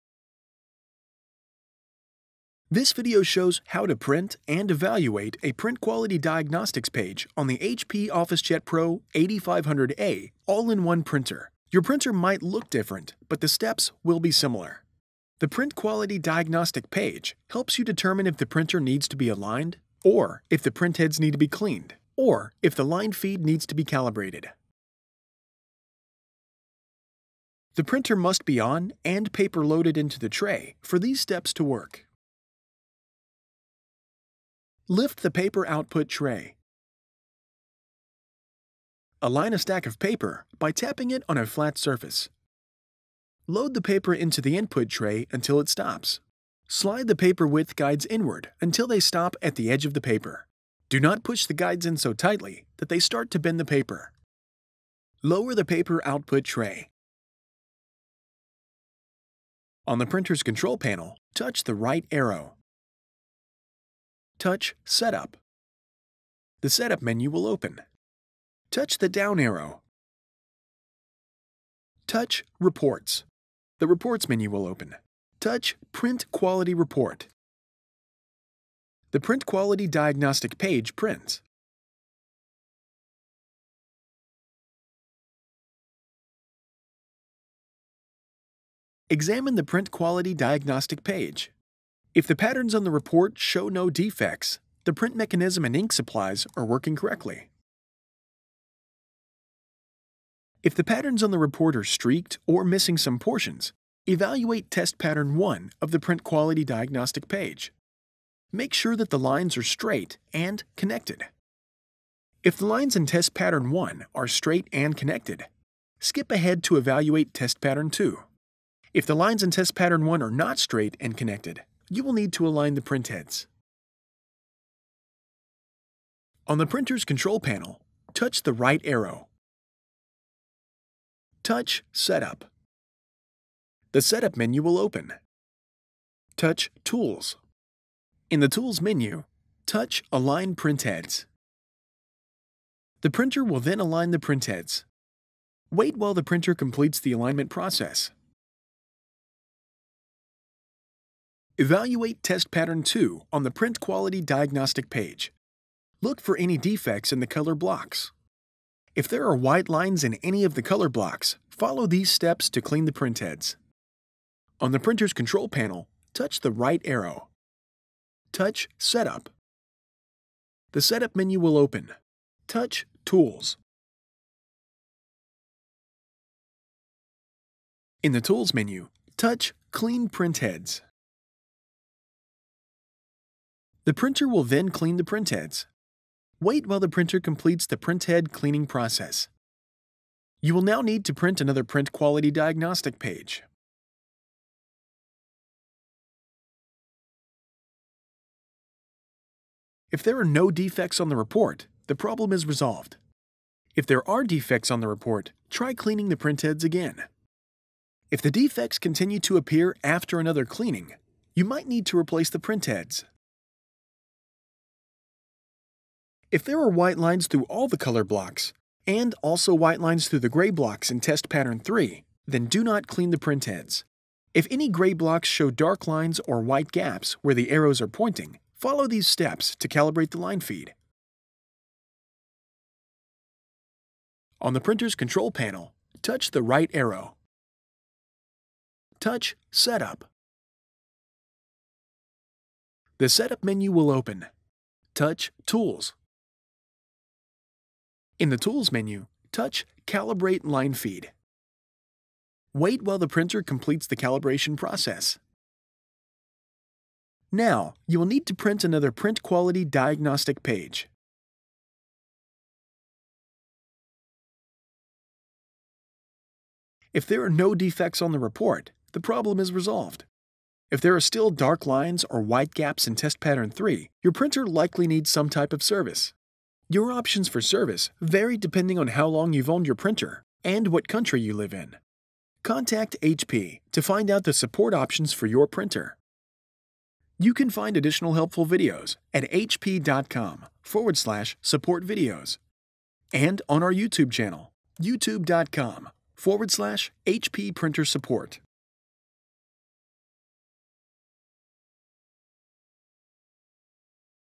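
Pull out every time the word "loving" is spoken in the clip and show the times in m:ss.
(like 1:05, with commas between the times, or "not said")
not said.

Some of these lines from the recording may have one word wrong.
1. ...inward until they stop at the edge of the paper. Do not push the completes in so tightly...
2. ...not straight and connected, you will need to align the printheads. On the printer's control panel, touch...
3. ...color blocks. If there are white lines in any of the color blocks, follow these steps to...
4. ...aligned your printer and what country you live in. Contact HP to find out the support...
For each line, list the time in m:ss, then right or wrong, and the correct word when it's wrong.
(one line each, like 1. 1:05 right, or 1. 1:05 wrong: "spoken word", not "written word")
1. 0:48 wrong: "guides", not "completes"
2. 2:00 right
3. 2:37 right
4. 4:39 wrong: "owned", not "aligned".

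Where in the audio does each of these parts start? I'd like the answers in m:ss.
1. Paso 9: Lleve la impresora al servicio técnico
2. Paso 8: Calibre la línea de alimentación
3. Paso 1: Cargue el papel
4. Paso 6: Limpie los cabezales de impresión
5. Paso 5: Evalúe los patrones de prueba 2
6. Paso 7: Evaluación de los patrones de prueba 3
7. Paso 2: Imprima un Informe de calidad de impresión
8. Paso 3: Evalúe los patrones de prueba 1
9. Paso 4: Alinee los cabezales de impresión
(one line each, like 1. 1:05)
1. 4:26
2. 3:52
3. 0:33
4. 2:44
5. 2:31
6. 3:34
7. 0:58
8. 1:38
9. 2:05.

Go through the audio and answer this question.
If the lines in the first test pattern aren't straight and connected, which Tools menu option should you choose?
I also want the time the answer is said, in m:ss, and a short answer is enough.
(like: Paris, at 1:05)
Align Printheads, at 2:20.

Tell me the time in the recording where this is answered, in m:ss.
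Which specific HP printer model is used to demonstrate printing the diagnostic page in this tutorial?
0:08.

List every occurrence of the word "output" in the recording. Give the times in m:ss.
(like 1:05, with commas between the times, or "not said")
0:35, 0:56.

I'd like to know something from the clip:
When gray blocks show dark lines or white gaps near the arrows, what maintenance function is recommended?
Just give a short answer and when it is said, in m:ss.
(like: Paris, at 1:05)
Calibrate Line Feed, at 4:09.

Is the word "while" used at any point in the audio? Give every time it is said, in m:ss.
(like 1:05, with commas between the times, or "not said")
2:25, 3:06, 4:12.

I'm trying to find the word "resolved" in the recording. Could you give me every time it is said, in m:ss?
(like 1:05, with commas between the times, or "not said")
3:22, 4:29.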